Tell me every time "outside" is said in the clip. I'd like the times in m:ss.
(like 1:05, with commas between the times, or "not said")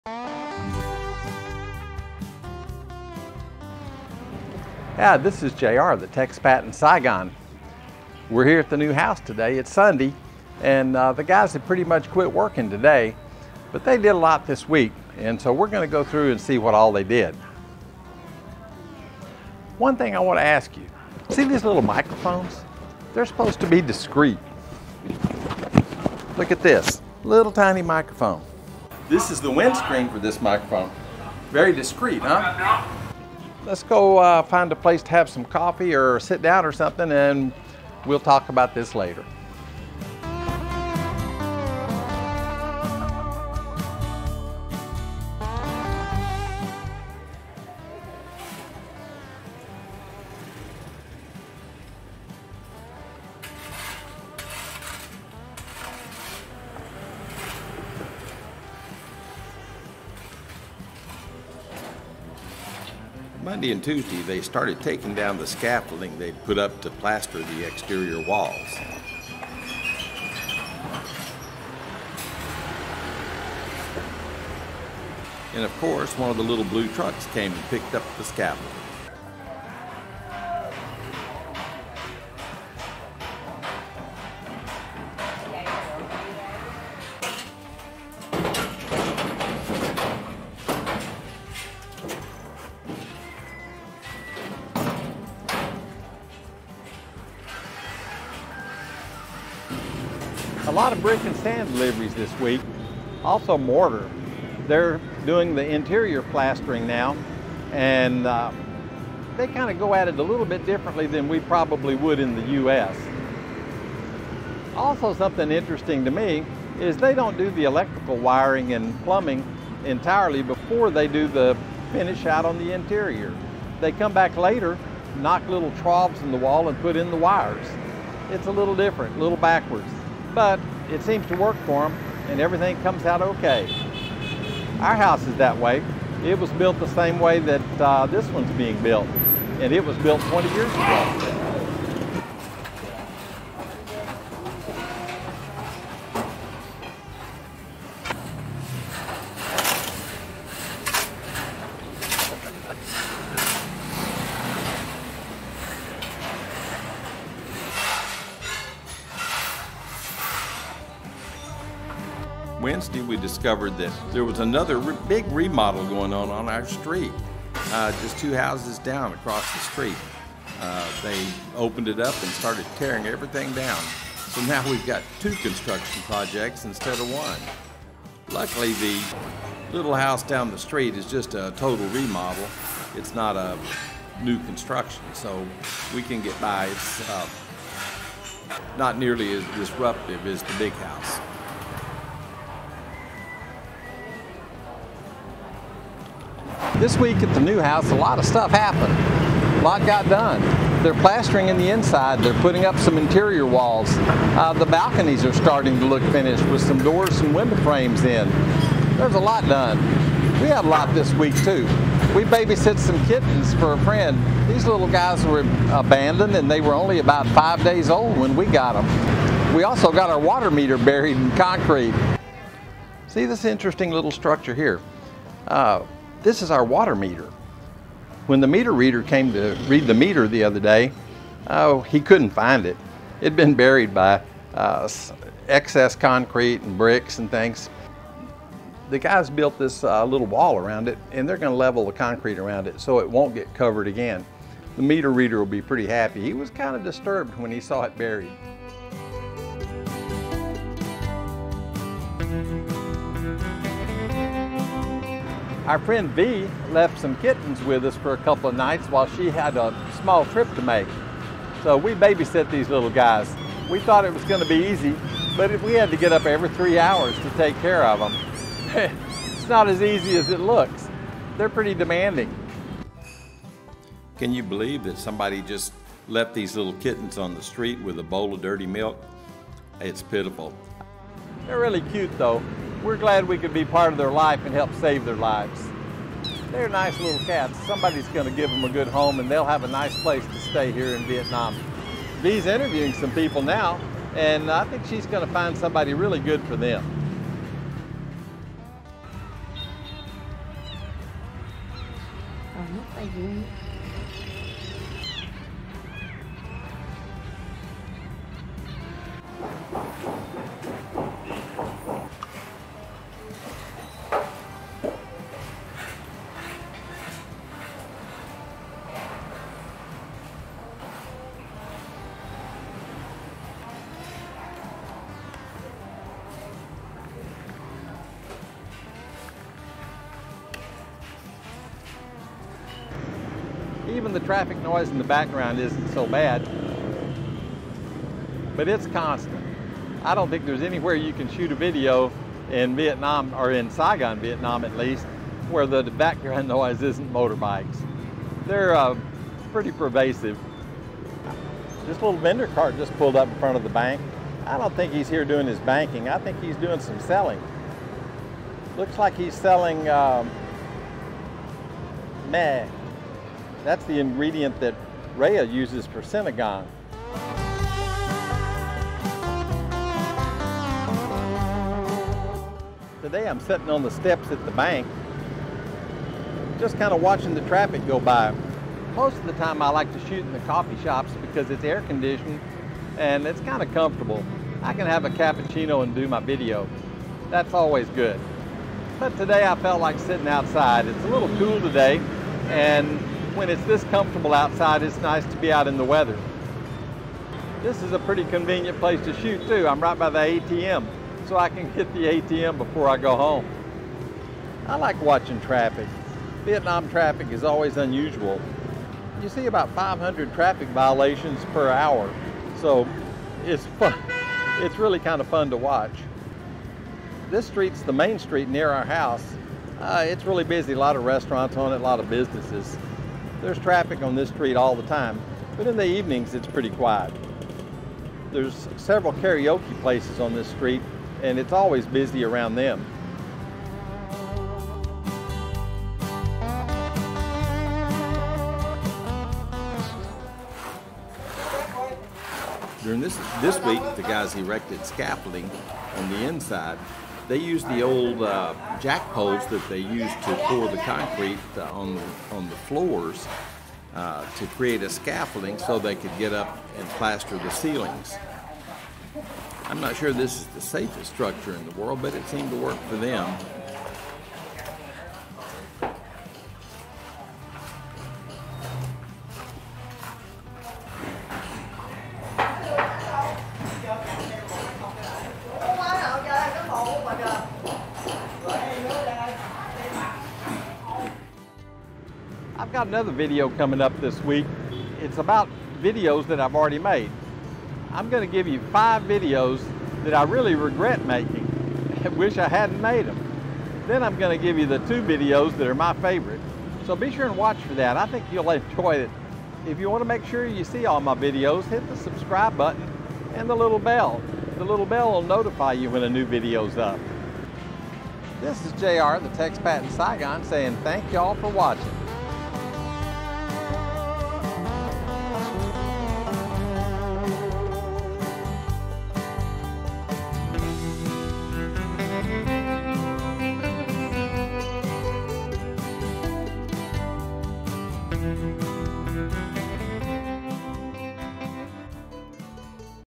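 6:30, 6:34.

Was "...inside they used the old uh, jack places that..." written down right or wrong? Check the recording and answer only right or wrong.
wrong.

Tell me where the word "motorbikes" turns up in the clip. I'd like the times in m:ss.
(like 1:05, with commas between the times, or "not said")
5:47.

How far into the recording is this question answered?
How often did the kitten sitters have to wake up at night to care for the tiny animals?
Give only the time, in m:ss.
4:26.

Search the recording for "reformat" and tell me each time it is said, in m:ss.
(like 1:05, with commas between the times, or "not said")
not said.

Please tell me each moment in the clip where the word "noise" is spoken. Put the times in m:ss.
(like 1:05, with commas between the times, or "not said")
5:34, 5:46.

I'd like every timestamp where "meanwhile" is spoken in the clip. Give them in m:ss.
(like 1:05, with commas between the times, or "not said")
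not said.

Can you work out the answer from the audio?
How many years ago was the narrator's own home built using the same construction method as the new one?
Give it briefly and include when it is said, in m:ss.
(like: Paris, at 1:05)
20, at 2:20.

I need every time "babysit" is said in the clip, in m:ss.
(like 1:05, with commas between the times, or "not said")
3:32, 4:21.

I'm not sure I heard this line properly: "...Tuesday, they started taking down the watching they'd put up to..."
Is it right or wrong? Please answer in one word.
wrong.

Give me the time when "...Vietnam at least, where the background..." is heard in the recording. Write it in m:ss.
5:44.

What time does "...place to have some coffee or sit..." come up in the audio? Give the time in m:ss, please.
0:34.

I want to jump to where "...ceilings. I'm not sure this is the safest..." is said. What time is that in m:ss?
7:37.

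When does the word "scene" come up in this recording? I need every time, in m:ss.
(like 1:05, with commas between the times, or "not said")
not said.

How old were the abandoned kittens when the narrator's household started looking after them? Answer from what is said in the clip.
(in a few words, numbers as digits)
about five days old.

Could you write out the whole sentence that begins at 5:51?
This little vendor cart just pulled up in front of the bank.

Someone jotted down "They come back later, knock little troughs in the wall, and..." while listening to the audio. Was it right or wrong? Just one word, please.
right.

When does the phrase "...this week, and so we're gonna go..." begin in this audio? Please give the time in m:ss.
0:14.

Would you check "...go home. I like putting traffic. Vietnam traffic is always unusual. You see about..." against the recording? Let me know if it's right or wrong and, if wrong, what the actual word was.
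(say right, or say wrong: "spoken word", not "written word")
wrong: "watching", not "putting".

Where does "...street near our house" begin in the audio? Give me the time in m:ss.
6:58.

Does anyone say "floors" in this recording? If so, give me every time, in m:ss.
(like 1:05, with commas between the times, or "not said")
7:32.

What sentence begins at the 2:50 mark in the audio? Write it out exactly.
Uh, they opened it up and started tearing everything down.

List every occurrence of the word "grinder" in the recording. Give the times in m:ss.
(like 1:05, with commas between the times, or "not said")
not said.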